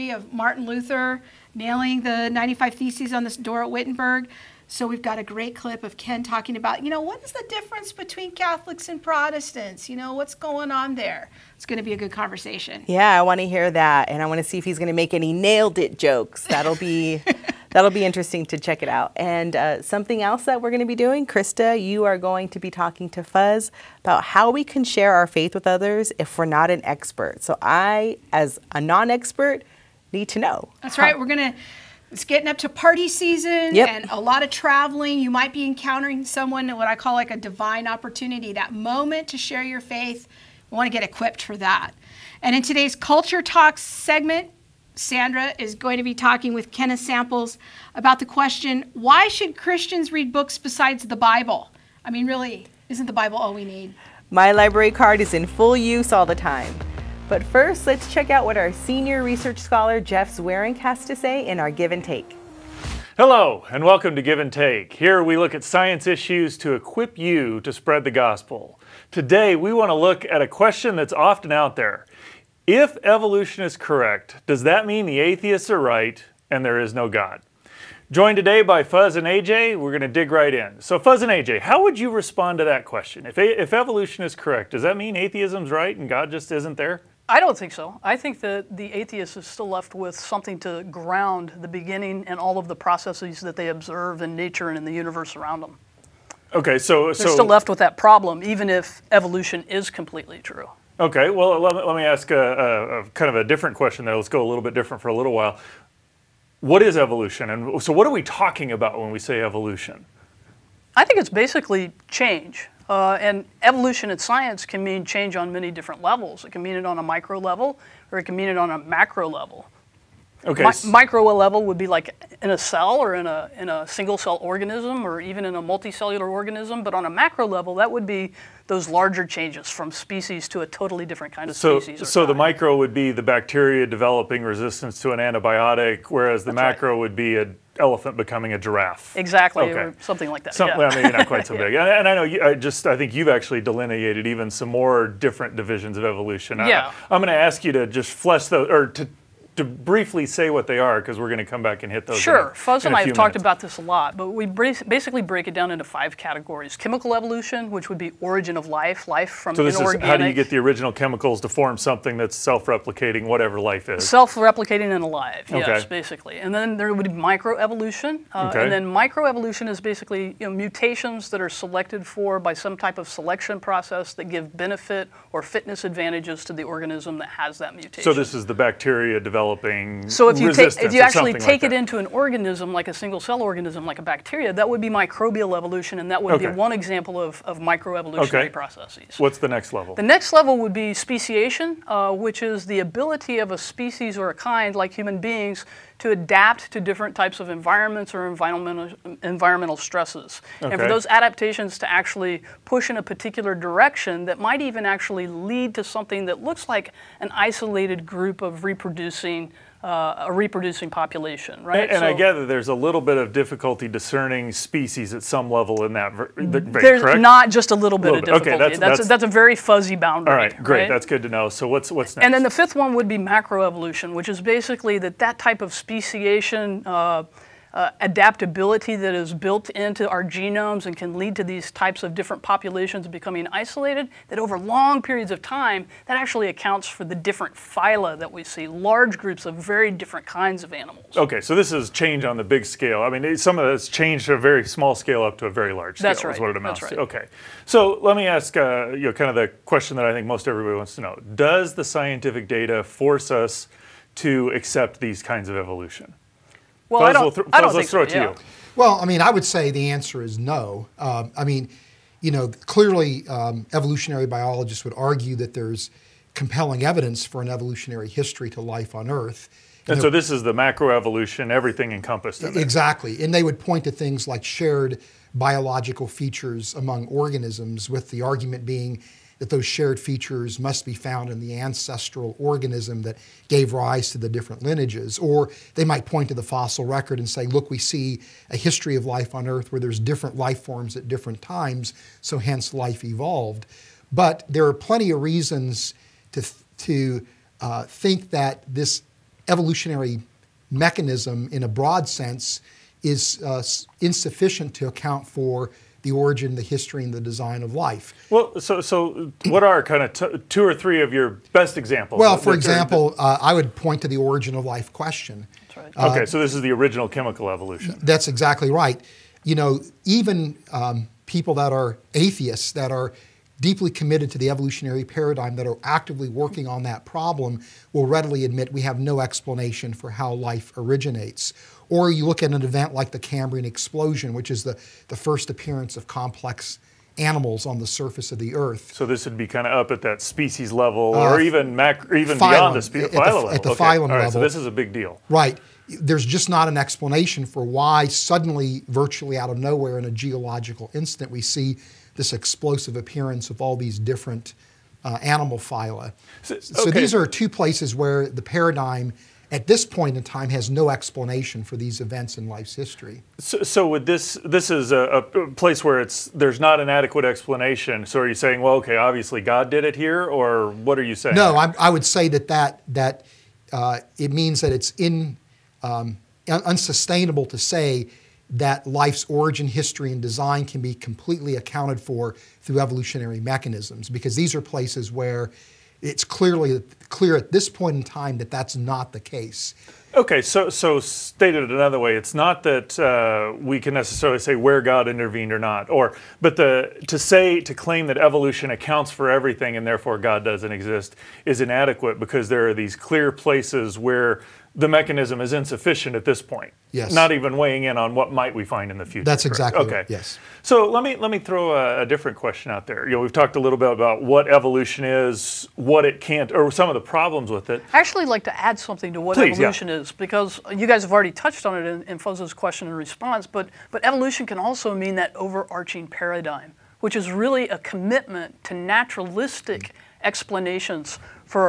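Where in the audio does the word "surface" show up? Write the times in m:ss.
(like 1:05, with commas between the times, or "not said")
5:37.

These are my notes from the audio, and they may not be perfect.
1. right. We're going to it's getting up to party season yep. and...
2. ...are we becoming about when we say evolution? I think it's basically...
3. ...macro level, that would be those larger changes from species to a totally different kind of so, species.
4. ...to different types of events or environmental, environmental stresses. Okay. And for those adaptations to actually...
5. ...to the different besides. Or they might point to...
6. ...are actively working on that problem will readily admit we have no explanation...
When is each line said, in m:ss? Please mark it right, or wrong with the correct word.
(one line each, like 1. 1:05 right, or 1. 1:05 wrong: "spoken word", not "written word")
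1. 0:31 right
2. 1:48 wrong: "talking", not "becoming"
3. 2:07 right
4. 3:16 wrong: "environments", not "events"
5. 4:44 wrong: "lineages", not "besides"
6. 5:25 right.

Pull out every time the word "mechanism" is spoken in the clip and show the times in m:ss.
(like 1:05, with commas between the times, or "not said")
5:00, 6:23, 6:44.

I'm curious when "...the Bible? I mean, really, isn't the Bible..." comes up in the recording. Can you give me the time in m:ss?
0:51.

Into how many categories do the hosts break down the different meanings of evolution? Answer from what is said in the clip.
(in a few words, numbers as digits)
5.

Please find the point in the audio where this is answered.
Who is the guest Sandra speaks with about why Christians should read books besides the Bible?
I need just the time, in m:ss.
0:46.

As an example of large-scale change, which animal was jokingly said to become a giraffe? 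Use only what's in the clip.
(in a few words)
An elephant.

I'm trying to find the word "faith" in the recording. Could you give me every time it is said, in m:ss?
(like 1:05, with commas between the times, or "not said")
0:25, 0:39.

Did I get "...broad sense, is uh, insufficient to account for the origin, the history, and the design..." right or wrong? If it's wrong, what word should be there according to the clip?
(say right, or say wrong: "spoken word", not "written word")
right.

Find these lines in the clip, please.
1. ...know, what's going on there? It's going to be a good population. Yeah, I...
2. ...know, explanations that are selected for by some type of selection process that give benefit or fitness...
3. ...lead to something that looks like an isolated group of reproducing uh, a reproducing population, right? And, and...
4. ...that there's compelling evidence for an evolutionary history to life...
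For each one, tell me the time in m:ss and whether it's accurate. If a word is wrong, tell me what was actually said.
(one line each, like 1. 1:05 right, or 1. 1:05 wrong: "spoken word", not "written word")
1. 0:09 wrong: "conversation", not "population"
2. 2:50 wrong: "mutations", not "explanations"
3. 3:25 right
4. 4:25 right.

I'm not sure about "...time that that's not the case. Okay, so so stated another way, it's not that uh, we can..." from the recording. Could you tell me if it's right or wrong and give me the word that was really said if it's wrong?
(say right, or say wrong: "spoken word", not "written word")
right.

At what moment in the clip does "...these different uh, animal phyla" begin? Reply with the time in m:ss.
5:53.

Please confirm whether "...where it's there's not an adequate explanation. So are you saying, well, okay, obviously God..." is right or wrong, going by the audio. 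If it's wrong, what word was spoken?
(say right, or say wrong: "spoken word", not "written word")
right.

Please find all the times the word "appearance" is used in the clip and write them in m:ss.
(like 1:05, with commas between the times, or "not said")
5:35, 5:52.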